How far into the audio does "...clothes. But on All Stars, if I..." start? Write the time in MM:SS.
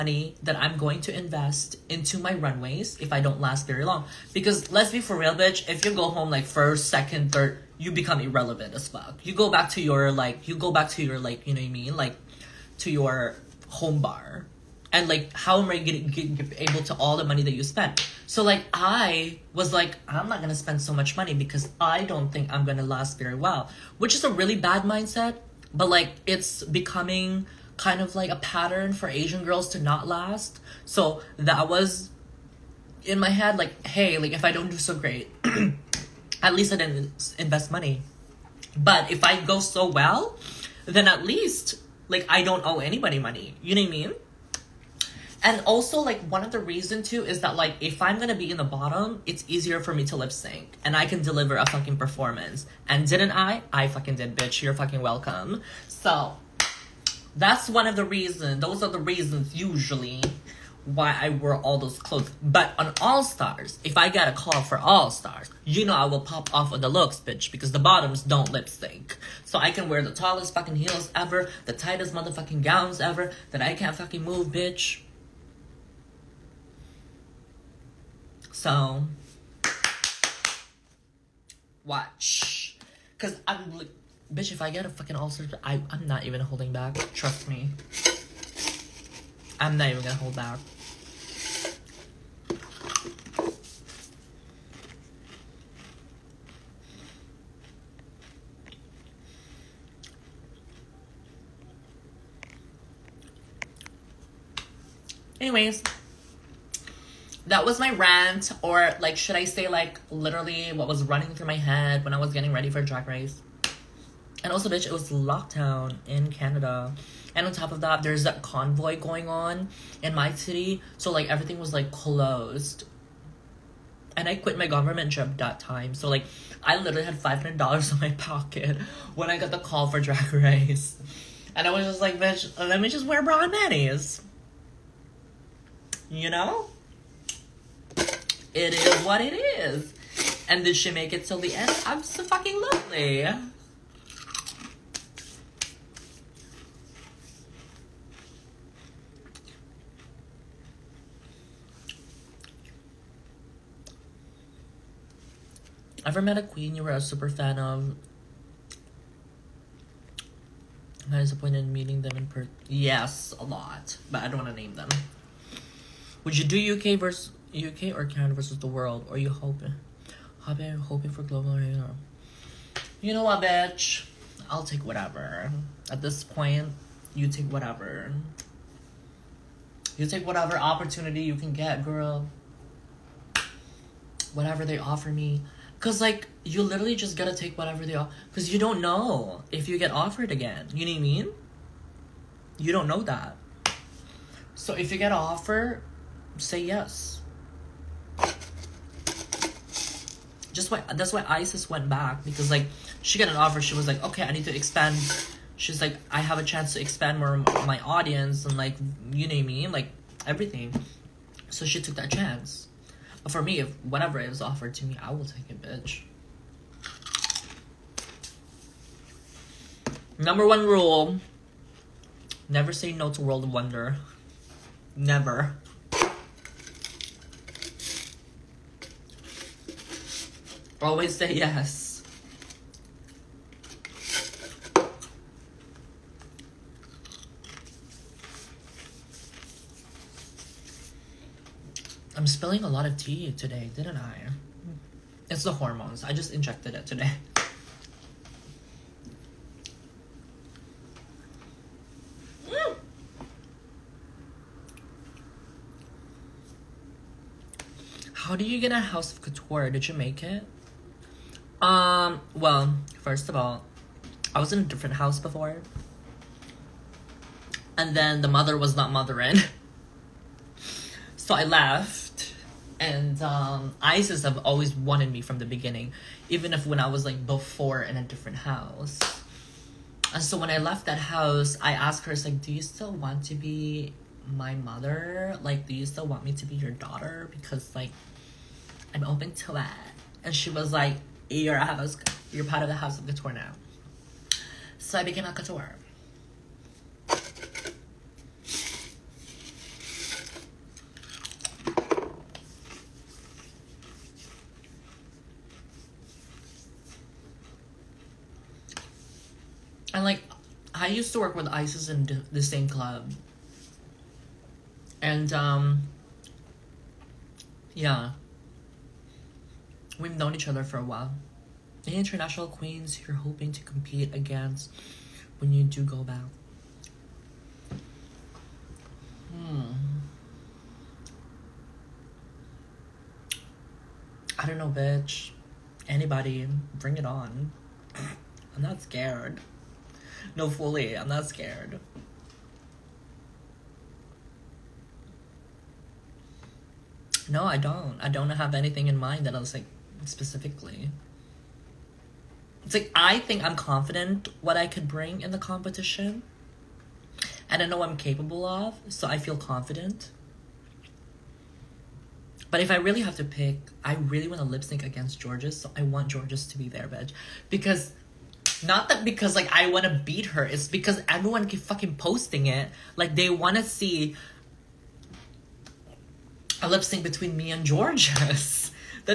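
01:01.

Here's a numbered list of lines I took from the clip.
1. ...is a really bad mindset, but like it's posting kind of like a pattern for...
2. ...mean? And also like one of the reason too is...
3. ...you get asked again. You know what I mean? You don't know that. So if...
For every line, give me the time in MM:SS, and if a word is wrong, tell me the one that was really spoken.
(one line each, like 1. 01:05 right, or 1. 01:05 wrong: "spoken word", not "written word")
1. 00:24 wrong: "becoming", not "posting"
2. 00:43 right
3. 03:09 wrong: "offered", not "asked".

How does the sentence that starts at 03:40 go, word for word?
Number one rule never say no to World of Wonder.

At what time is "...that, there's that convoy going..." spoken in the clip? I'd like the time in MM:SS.
01:57.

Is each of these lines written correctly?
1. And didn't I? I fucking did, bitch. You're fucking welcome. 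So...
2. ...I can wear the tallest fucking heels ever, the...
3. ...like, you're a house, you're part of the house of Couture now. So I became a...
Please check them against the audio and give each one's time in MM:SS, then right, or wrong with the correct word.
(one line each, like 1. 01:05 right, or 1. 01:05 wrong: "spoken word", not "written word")
1. 00:52 right
2. 01:09 right
3. 04:50 right.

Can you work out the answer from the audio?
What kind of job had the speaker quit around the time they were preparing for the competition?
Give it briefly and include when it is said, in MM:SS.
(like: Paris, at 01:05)
government job, at 02:04.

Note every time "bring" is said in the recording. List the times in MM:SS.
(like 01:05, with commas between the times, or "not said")
05:36, 05:54.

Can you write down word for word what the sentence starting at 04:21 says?
Um, well, first of all, I was in a different house before.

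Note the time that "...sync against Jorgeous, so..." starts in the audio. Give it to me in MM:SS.
06:04.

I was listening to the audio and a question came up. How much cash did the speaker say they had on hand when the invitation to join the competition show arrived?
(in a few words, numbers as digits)
$500.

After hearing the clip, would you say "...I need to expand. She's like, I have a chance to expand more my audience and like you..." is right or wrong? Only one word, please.
right.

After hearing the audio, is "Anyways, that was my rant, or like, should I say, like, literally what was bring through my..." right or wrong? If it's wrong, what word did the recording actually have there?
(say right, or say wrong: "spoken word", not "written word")
wrong: "running", not "bring".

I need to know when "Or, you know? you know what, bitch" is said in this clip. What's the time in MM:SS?
02:51.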